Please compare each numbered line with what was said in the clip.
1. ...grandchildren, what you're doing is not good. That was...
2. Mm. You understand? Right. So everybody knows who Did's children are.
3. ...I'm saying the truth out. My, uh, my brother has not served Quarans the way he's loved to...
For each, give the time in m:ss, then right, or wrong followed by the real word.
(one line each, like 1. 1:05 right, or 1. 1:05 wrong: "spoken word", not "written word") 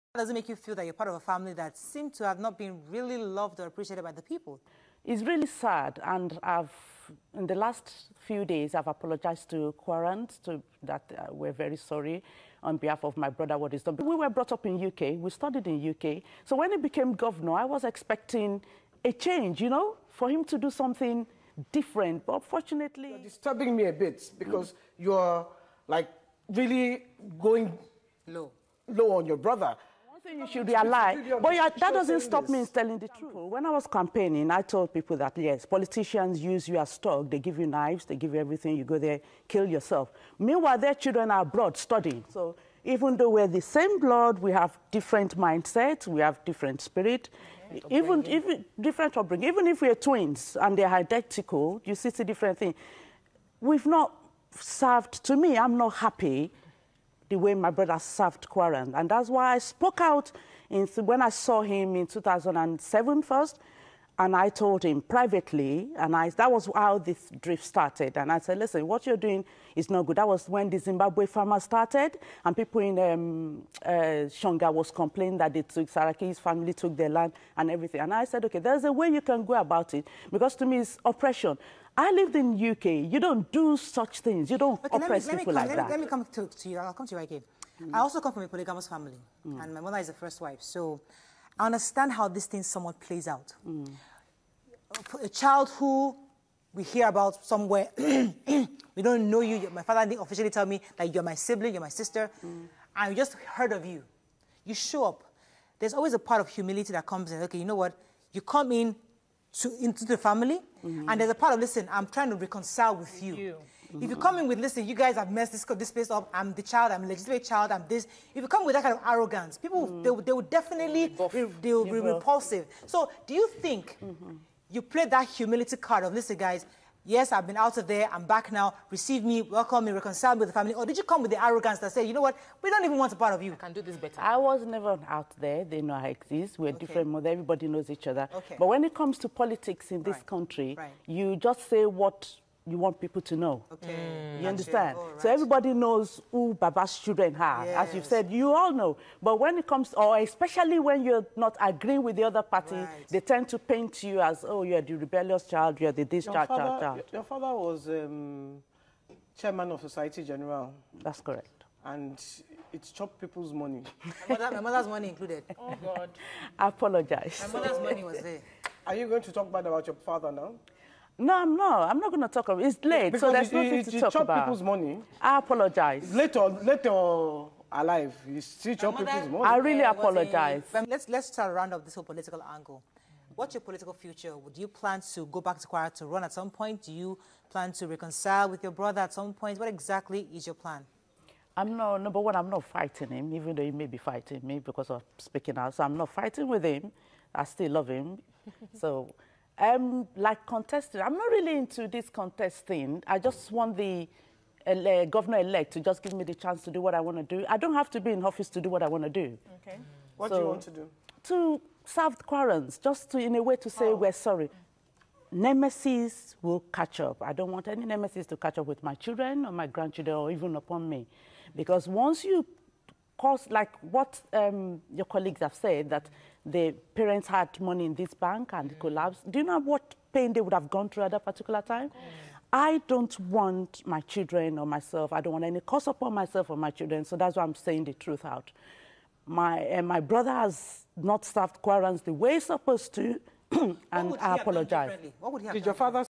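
1. 1:08 wrong: "listen", not "grandchildren"
2. 2:23 wrong: "Baba", not "Did"
3. 3:57 wrong: "supposed", not "loved".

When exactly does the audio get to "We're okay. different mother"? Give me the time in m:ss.
2:16.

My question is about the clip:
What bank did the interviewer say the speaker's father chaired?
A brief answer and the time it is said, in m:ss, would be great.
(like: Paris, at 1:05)
Societe Generale, at 2:39.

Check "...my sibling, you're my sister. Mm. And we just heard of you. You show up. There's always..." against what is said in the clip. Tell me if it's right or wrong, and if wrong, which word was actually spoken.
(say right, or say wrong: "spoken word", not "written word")
right.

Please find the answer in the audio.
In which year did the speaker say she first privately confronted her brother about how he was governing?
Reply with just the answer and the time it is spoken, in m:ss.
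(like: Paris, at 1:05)
2007, at 1:02.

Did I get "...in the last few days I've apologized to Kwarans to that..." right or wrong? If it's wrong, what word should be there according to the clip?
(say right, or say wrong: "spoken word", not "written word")
right.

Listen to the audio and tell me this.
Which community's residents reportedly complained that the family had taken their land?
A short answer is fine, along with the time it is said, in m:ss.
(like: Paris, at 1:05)
Shonga, at 1:14.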